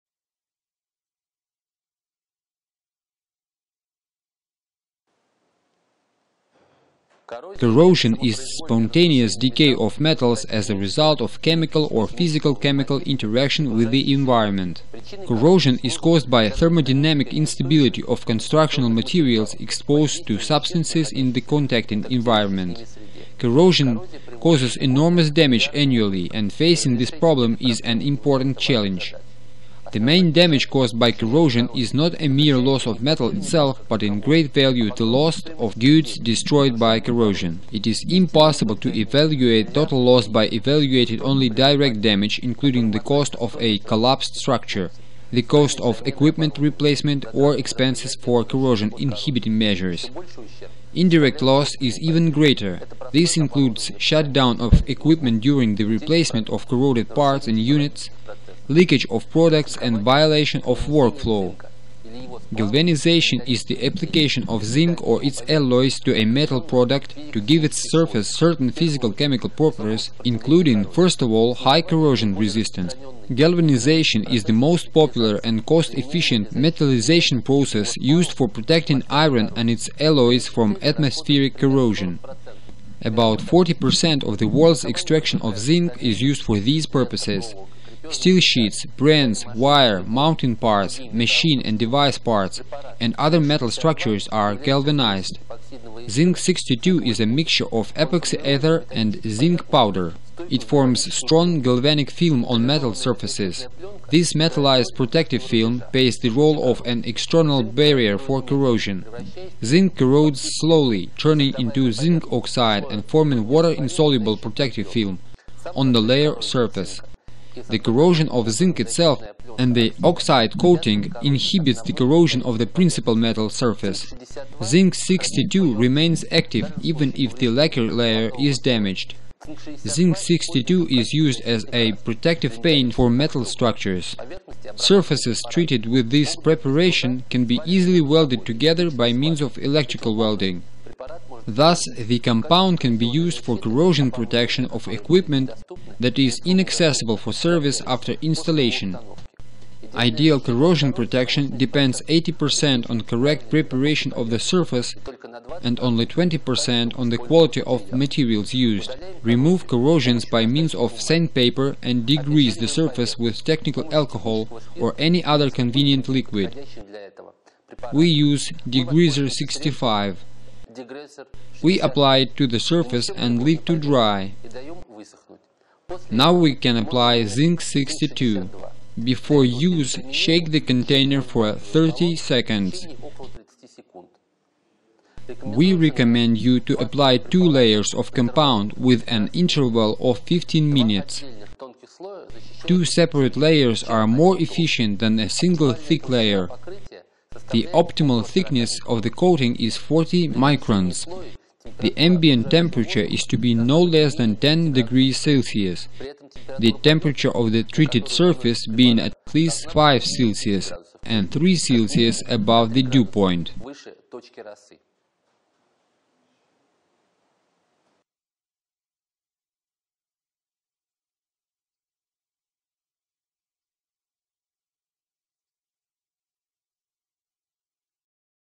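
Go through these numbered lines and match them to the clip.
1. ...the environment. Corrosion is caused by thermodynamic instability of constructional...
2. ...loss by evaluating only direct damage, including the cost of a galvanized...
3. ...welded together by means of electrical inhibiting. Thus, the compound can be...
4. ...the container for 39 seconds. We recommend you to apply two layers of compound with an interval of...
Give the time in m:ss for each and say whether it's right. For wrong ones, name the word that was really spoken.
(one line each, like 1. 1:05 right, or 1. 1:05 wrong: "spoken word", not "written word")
1. 0:13 right
2. 0:40 wrong: "collapsed", not "galvanized"
3. 2:18 wrong: "welding", not "inhibiting"
4. 3:00 wrong: "30", not "39".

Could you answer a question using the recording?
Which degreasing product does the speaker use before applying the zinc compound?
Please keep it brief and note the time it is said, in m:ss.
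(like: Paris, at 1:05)
degreaser 65, at 2:48.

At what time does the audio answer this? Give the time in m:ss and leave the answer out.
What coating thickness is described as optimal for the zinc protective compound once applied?
3:19.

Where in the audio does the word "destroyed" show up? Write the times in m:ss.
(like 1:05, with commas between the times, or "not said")
0:36.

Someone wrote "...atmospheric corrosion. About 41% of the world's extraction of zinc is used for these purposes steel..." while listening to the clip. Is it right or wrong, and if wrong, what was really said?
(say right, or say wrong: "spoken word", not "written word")
wrong: "40", not "41".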